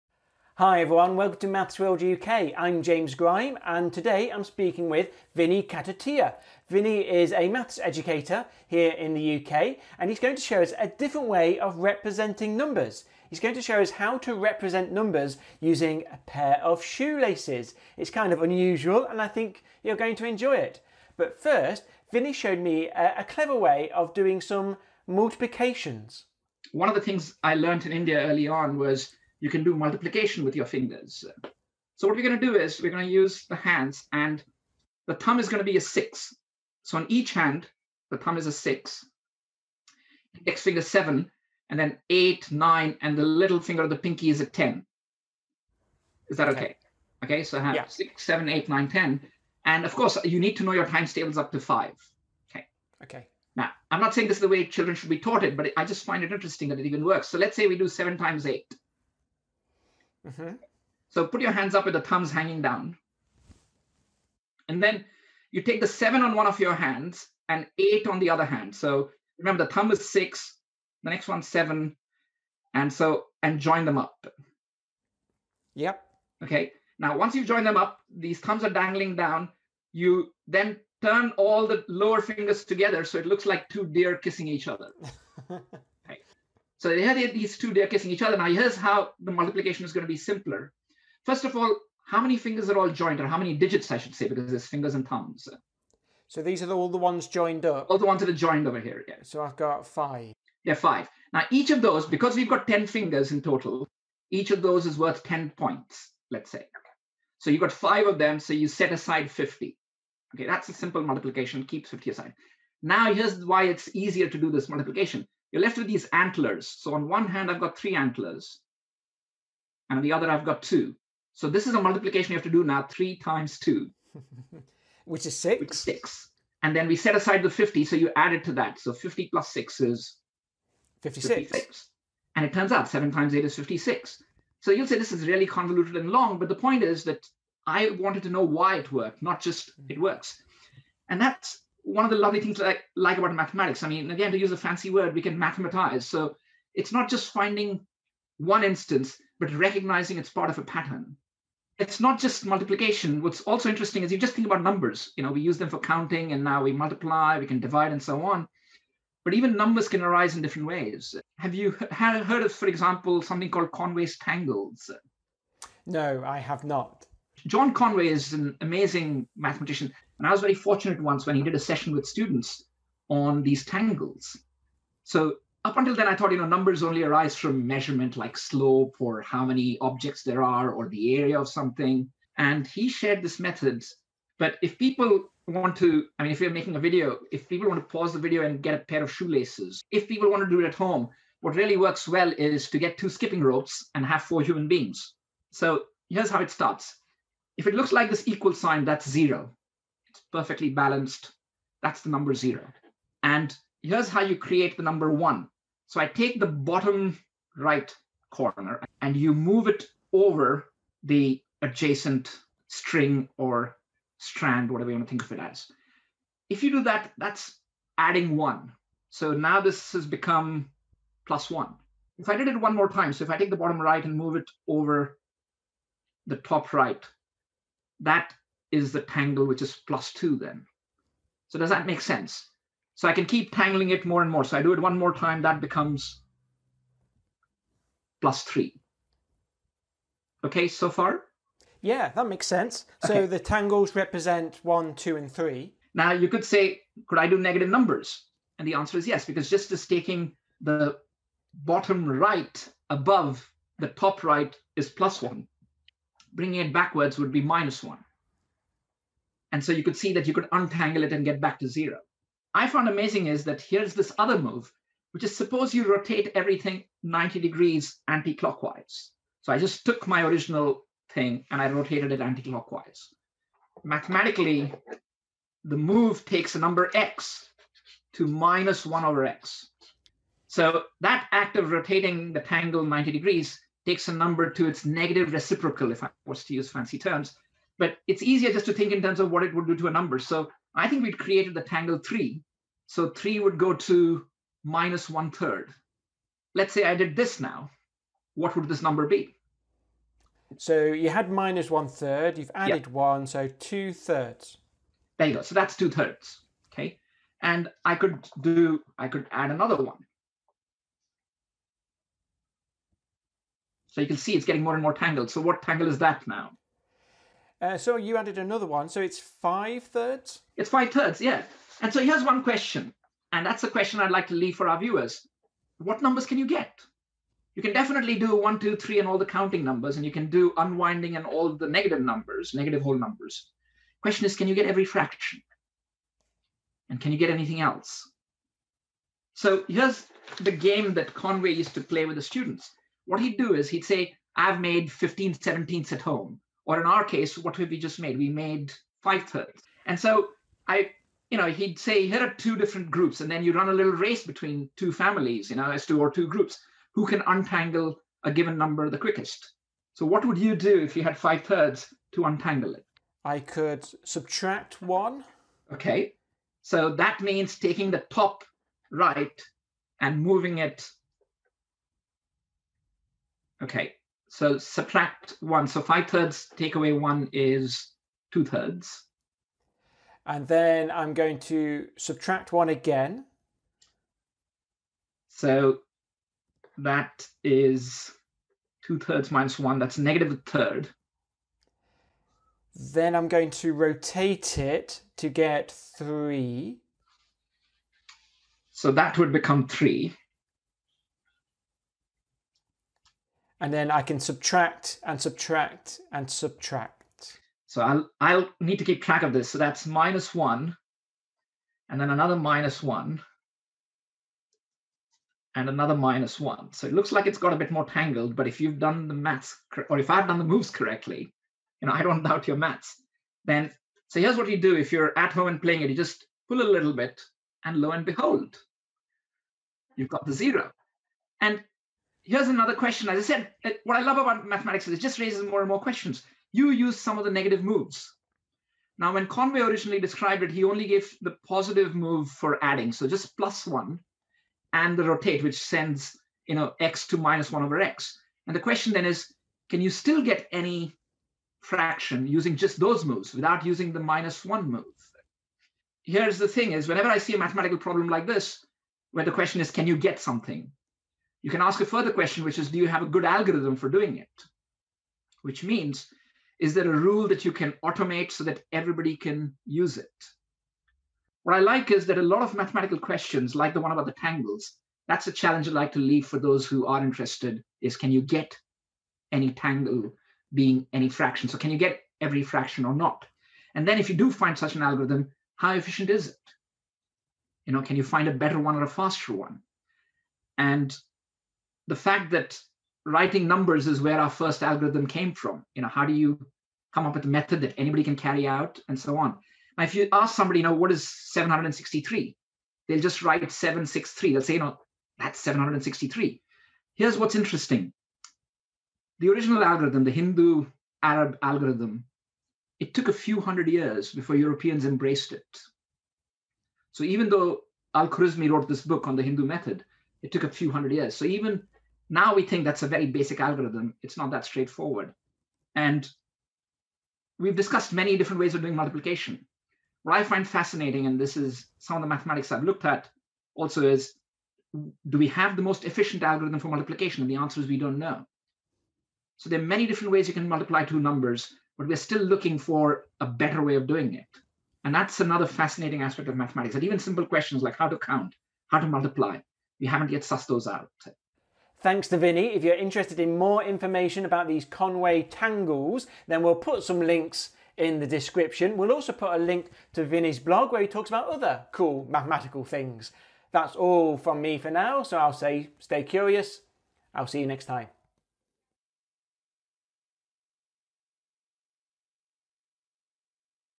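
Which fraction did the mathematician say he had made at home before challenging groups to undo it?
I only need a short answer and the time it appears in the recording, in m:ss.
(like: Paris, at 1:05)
15/17, at 5:44.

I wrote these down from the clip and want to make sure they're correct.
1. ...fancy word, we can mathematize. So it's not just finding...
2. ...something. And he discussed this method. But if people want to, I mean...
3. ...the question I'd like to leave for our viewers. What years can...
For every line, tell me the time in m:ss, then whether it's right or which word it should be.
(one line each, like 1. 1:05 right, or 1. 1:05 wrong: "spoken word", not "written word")
1. 2:24 right
2. 3:01 wrong: "shared", not "discussed"
3. 5:23 wrong: "numbers", not "years".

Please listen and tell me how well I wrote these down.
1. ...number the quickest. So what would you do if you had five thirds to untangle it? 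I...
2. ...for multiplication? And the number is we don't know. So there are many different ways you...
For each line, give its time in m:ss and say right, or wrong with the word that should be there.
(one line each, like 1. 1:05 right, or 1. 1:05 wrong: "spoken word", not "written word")
1. 5:58 right
2. 8:56 wrong: "answer", not "number".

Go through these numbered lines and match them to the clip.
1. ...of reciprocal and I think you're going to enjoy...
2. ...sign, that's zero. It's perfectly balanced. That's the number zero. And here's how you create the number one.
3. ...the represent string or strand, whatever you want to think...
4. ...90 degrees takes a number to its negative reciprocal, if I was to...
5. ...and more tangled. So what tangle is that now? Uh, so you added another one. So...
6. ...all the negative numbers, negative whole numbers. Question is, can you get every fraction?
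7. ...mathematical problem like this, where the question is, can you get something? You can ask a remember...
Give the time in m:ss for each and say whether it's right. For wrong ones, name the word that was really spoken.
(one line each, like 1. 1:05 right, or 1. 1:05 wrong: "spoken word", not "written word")
1. 0:18 wrong: "unusual", not "reciprocal"
2. 3:18 right
3. 3:31 wrong: "adjacent", not "represent"
4. 4:42 right
5. 5:14 right
6. 5:31 right
7. 7:37 wrong: "further", not "remember".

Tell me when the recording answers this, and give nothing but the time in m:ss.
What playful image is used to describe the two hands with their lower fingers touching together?
1:23.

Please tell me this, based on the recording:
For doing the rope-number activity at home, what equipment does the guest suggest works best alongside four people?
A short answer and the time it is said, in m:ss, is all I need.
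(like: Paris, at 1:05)
Two skipping ropes, at 3:12.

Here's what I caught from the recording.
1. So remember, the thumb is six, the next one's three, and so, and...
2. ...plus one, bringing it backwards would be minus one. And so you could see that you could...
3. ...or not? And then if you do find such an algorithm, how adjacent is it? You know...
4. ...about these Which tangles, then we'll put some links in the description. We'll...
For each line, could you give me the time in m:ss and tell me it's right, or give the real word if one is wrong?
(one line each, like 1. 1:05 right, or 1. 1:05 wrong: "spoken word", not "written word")
1. 1:08 wrong: "seven", not "three"
2. 4:14 right
3. 8:02 wrong: "efficient", not "adjacent"
4. 9:14 wrong: "Conway", not "Which".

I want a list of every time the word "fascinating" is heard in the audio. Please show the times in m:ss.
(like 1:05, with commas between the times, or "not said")
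8:50, 9:05.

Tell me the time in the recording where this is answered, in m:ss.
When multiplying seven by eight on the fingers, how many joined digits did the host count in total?
1:39.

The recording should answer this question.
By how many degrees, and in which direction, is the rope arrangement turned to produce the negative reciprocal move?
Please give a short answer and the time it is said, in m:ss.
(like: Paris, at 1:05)
90 degrees anti-clockwise, at 4:27.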